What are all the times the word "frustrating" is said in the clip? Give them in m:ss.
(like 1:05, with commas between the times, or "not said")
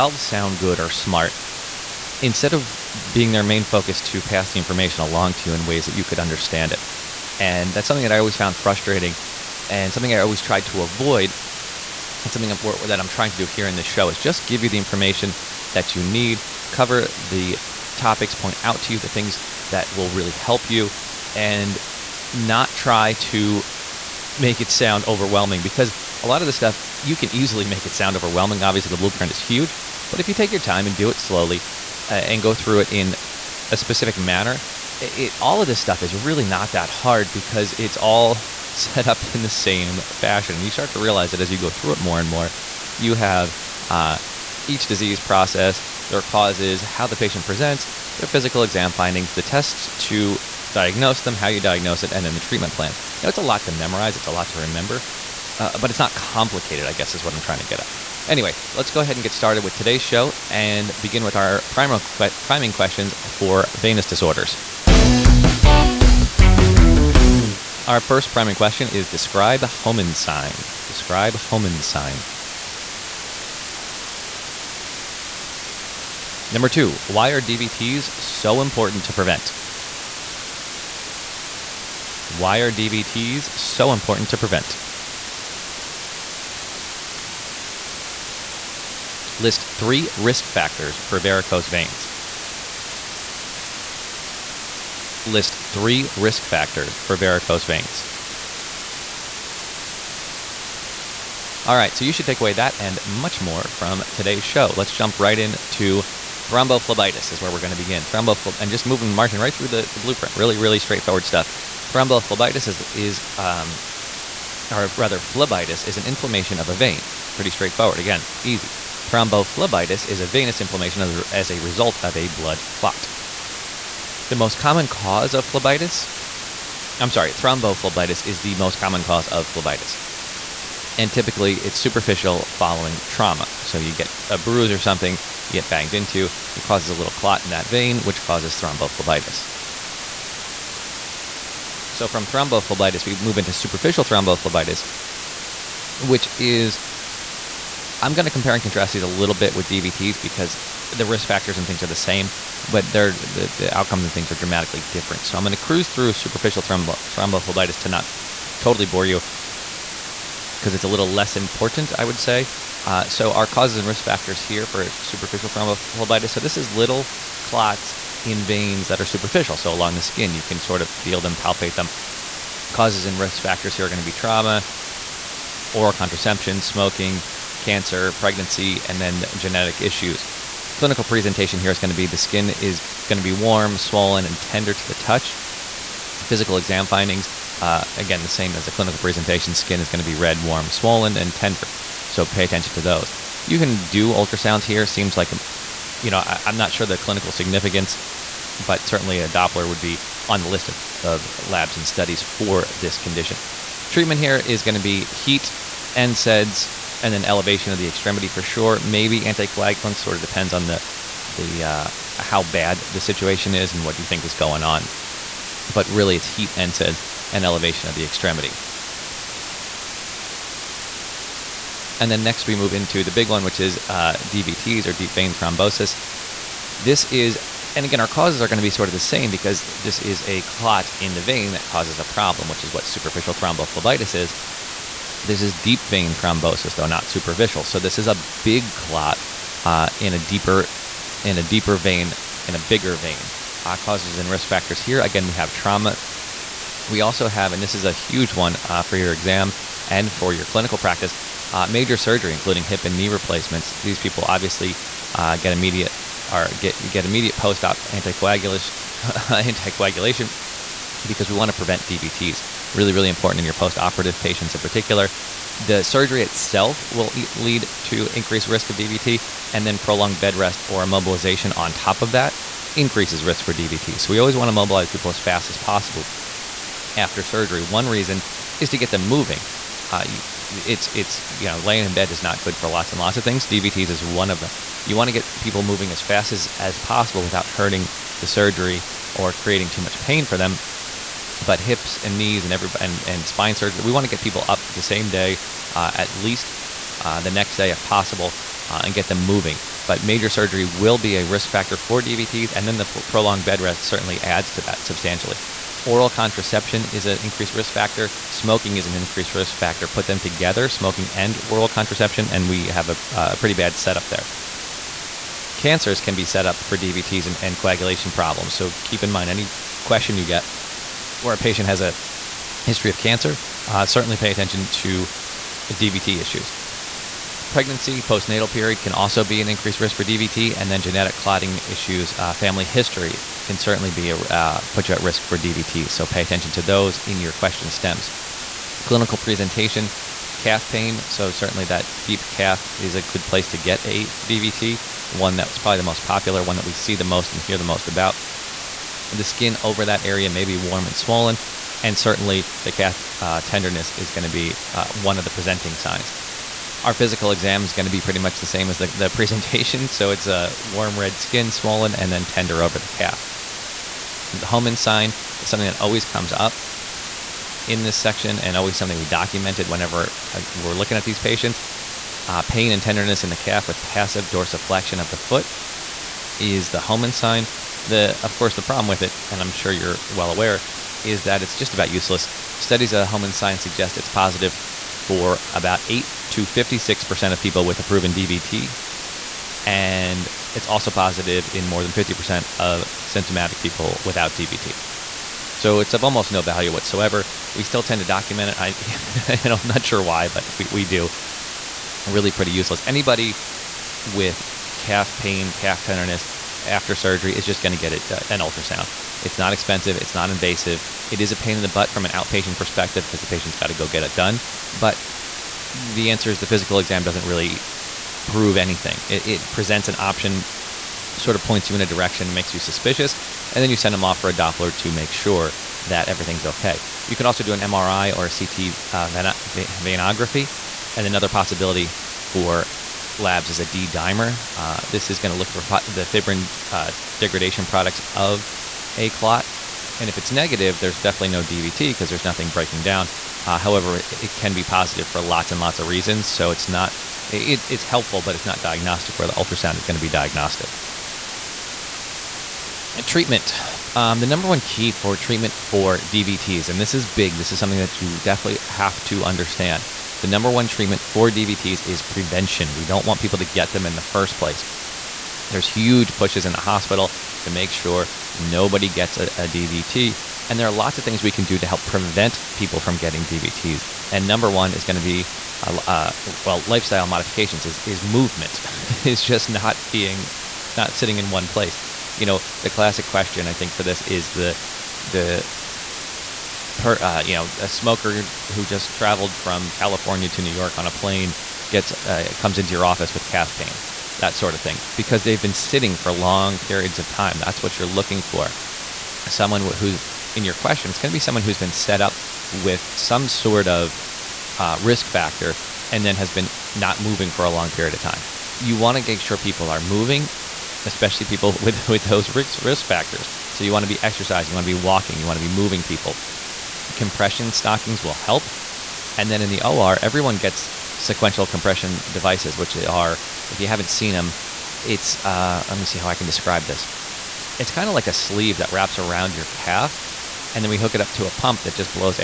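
0:08.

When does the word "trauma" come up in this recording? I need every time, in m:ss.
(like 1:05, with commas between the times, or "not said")
2:13, 2:54, 4:05.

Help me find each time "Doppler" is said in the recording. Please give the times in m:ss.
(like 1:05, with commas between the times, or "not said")
3:19, 7:04.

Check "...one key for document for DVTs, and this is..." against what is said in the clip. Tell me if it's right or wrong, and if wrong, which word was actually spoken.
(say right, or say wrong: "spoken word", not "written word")
wrong: "treatment", not "document".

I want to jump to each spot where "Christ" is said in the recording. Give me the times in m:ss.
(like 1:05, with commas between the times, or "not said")
not said.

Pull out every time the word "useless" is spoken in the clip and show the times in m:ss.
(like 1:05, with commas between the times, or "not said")
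6:21, 6:42.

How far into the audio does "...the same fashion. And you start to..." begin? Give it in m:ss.
0:39.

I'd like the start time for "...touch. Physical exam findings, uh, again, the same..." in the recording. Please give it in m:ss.
3:04.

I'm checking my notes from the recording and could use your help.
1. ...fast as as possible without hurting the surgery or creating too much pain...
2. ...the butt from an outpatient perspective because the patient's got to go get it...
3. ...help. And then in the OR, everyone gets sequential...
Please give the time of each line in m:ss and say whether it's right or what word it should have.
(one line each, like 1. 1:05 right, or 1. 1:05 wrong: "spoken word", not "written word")
1. 4:45 right
2. 6:51 right
3. 8:38 right.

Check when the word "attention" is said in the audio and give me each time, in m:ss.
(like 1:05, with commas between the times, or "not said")
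3:12, 5:24, 5:36.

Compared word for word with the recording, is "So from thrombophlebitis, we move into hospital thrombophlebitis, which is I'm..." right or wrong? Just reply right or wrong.
wrong.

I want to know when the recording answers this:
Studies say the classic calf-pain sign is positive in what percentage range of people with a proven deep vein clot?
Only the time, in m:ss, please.
6:25.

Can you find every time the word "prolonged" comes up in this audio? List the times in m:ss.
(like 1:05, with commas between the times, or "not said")
4:29, 5:03.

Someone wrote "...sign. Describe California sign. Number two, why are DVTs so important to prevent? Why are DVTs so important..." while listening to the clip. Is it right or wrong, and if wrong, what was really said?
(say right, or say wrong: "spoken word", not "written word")
wrong: "Homan", not "California".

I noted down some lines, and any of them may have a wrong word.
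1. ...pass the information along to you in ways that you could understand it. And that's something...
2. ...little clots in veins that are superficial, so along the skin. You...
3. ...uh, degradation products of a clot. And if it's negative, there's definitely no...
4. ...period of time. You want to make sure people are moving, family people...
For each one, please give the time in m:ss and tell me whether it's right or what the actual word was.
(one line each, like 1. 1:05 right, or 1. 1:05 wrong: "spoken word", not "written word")
1. 0:04 right
2. 2:46 right
3. 7:16 right
4. 8:27 wrong: "especially", not "family".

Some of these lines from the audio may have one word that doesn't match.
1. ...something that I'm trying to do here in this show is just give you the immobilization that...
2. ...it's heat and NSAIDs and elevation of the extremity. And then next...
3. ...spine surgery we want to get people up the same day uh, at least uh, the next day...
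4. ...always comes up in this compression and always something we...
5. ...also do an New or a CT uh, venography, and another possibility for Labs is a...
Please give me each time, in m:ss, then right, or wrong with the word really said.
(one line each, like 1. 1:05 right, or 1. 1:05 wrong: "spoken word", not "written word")
1. 0:12 wrong: "information", not "immobilization"
2. 3:36 right
3. 4:53 right
4. 6:05 wrong: "section", not "compression"
5. 7:07 wrong: "MRI", not "New".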